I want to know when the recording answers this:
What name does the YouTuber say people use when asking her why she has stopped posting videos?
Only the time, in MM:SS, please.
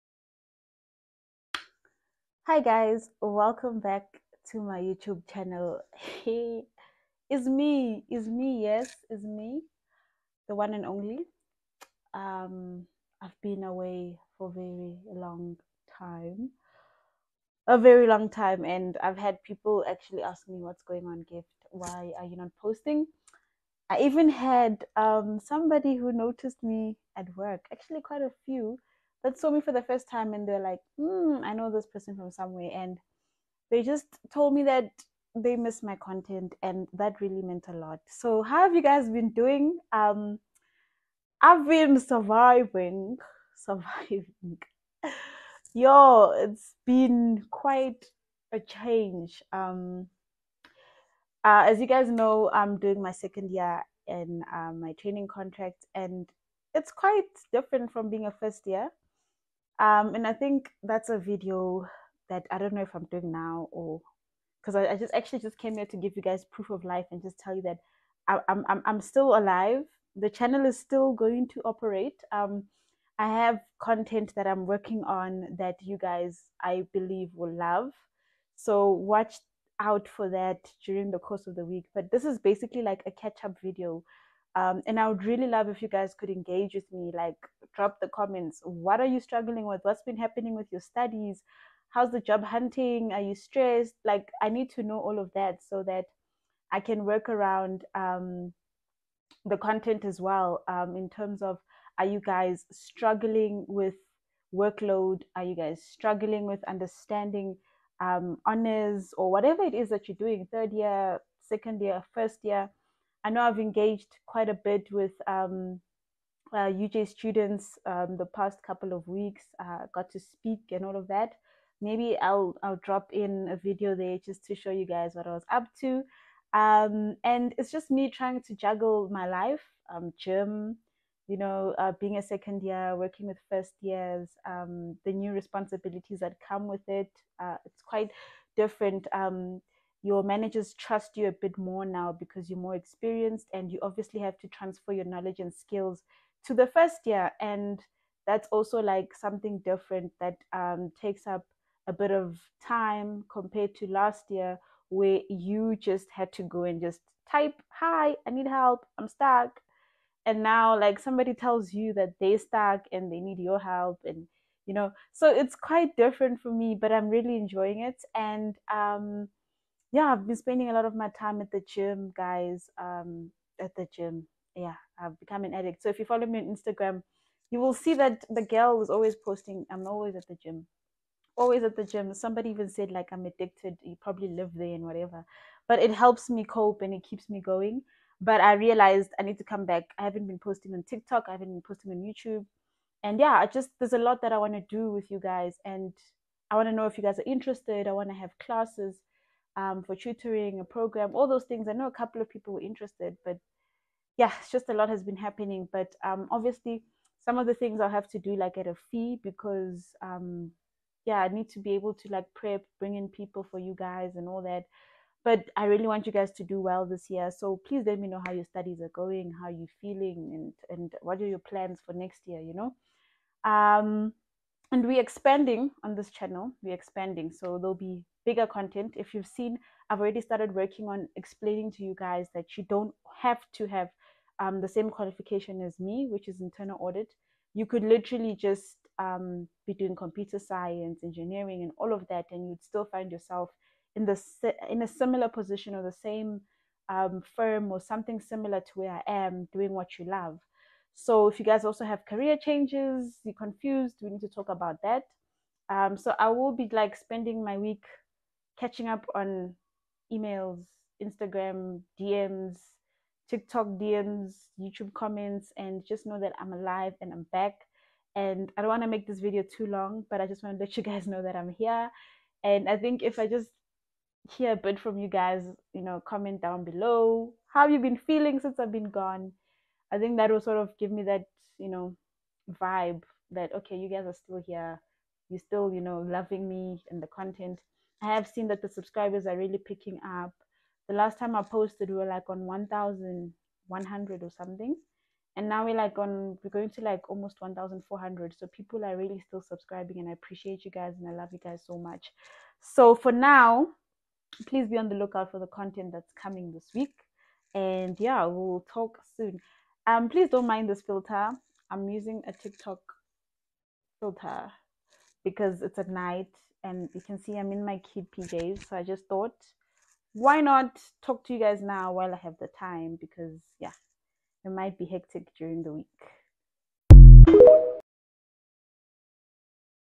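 00:21.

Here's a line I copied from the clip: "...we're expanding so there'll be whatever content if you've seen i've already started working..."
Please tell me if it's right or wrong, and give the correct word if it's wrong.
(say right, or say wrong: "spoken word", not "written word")
wrong: "bigger", not "whatever".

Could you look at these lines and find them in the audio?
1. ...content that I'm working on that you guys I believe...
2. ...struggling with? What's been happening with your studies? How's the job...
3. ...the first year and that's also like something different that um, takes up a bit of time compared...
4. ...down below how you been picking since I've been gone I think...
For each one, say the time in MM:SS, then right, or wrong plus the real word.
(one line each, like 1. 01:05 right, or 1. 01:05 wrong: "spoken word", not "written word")
1. 01:13 right
2. 01:29 right
3. 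02:26 right
4. 04:36 wrong: "feeling", not "picking".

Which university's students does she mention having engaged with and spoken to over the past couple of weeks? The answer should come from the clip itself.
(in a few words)
UJ.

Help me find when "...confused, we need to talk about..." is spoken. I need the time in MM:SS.
04:13.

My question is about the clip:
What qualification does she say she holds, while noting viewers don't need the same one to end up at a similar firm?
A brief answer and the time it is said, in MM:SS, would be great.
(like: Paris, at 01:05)
Internal audit, at 03:56.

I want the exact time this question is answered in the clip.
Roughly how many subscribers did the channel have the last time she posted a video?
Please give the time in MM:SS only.
04:52.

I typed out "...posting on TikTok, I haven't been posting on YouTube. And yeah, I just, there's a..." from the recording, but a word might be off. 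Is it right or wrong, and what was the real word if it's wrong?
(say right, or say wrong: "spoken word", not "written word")
right.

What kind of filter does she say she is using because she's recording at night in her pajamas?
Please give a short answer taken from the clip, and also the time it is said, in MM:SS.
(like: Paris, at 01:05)
TikTok filter, at 05:12.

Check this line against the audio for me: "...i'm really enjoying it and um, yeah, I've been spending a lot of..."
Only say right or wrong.
right.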